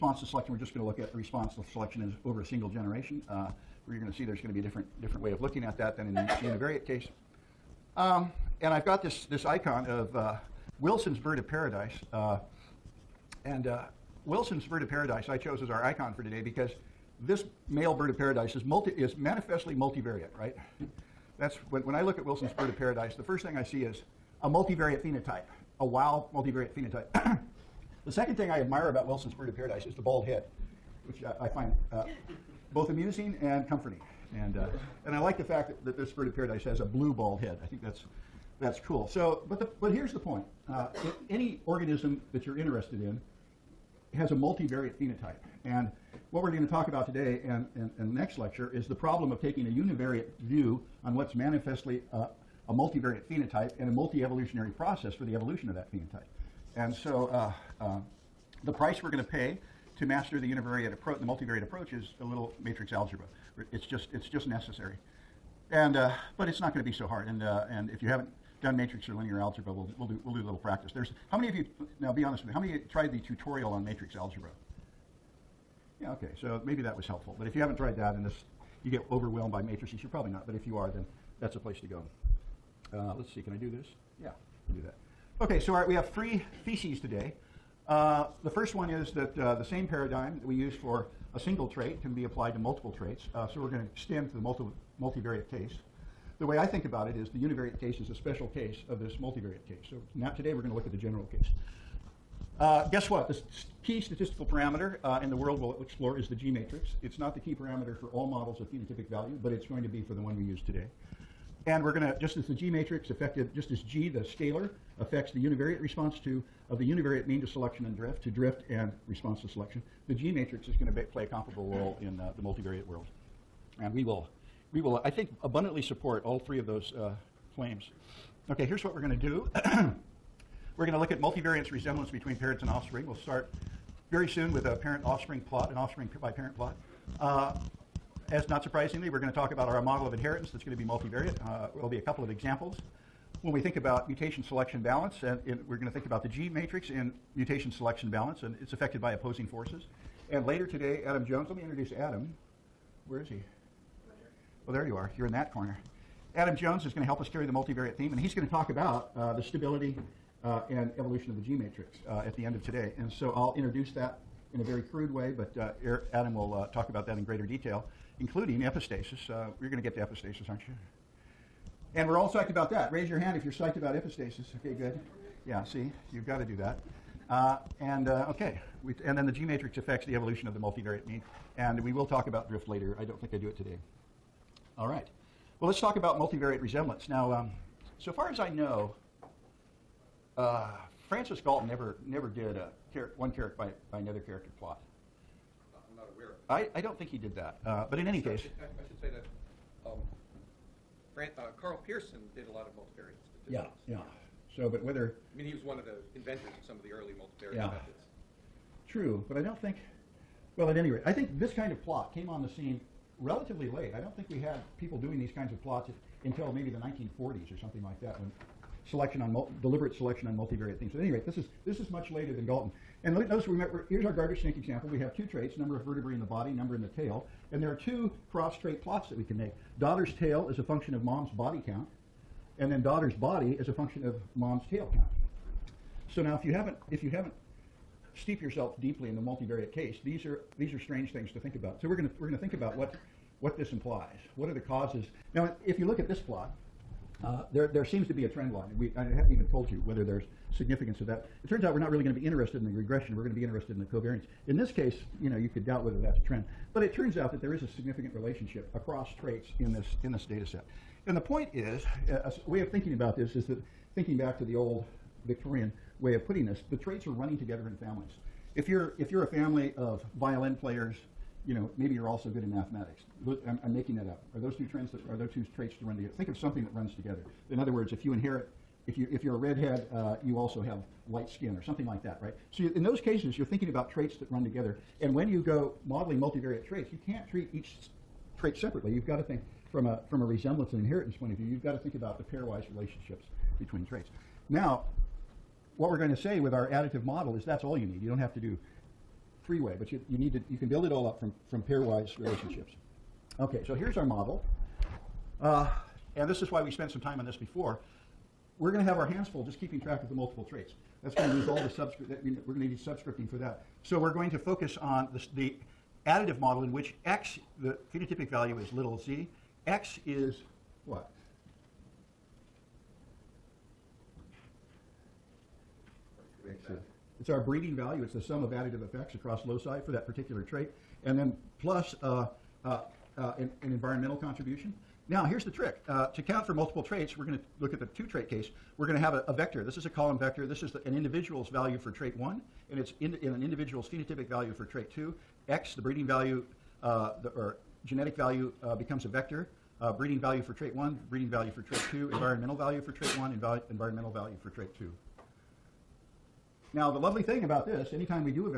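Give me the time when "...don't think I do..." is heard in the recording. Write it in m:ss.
3:03.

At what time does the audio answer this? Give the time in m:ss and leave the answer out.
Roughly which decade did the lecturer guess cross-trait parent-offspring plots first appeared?
3:36.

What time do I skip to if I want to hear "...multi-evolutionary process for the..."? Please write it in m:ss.
0:53.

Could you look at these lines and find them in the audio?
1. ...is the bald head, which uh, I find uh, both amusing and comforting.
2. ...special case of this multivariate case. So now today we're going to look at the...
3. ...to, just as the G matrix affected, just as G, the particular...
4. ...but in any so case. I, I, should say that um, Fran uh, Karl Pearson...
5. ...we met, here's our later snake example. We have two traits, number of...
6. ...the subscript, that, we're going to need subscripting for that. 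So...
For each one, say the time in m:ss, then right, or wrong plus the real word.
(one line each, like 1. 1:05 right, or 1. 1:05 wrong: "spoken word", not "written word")
1. 0:29 right
2. 1:38 right
3. 1:52 wrong: "scalar", not "particular"
4. 3:17 right
5. 3:43 wrong: "garter", not "later"
6. 5:11 right.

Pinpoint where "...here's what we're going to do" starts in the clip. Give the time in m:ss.
2:08.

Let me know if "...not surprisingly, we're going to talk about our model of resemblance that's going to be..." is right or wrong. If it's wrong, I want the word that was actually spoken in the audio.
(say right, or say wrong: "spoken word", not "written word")
wrong: "inheritance", not "resemblance".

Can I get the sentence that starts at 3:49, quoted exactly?
Daughter's tail is a function of mom's body count, and then daughter's body is a function of mom's tail count.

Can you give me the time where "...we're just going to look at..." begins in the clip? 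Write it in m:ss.
0:00.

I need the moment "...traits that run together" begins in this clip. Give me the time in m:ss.
4:43.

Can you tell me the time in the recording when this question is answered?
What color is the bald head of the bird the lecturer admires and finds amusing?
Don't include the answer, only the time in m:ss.
0:36.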